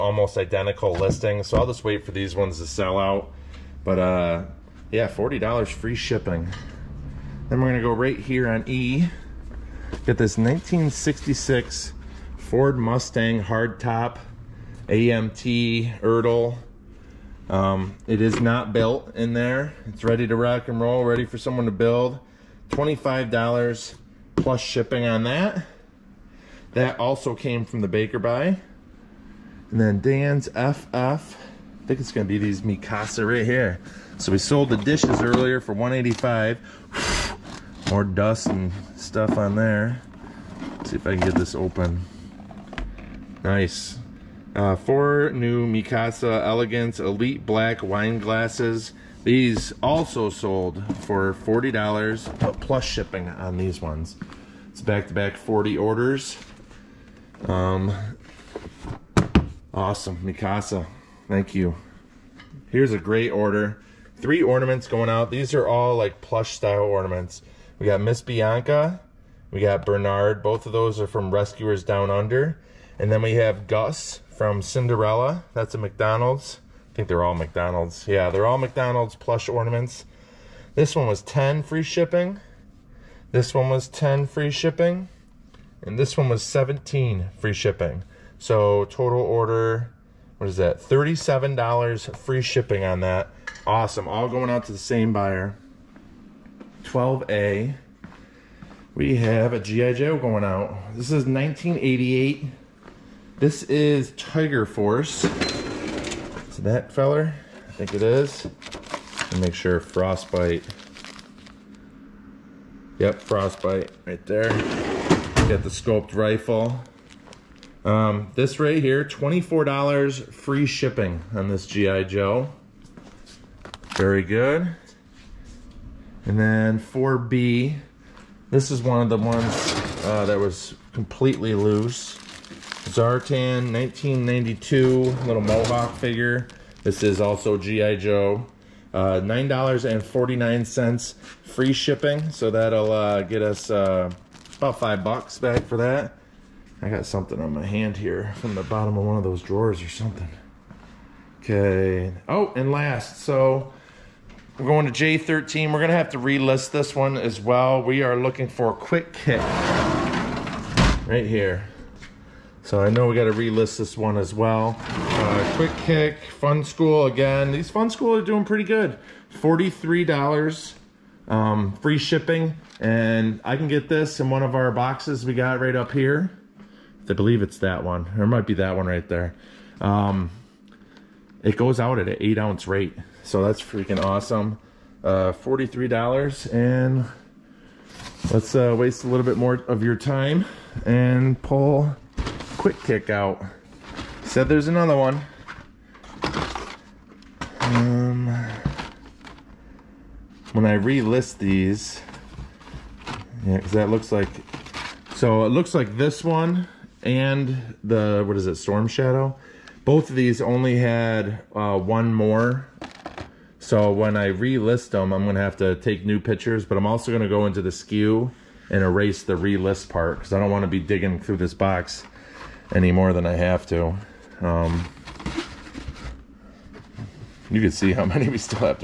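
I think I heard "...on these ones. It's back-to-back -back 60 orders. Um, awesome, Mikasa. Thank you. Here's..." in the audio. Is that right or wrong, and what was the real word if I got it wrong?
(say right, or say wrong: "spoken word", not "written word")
wrong: "40", not "60".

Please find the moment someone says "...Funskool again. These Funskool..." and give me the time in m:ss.
2:46.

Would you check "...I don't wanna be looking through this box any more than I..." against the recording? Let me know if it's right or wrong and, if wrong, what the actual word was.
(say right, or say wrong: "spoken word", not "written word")
wrong: "digging", not "looking".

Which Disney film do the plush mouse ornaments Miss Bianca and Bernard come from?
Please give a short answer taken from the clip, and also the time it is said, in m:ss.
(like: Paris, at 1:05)
Rescuers Down Under, at 1:11.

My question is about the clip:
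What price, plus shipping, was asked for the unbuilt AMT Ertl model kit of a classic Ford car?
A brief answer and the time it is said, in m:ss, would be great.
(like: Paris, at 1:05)
$25, at 0:22.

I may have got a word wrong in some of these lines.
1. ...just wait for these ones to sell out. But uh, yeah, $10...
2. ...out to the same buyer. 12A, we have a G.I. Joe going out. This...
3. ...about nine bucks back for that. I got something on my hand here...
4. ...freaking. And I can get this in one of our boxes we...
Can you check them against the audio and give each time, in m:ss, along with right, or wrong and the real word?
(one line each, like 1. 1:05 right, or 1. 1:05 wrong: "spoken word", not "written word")
1. 0:01 wrong: "40", not "10"
2. 1:34 right
3. 2:24 wrong: "five", not "nine"
4. 2:51 wrong: "shipping", not "freaking".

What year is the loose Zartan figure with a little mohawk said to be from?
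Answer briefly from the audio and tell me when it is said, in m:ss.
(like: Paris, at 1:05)
1992, at 2:13.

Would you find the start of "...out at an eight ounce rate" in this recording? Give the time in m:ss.
3:01.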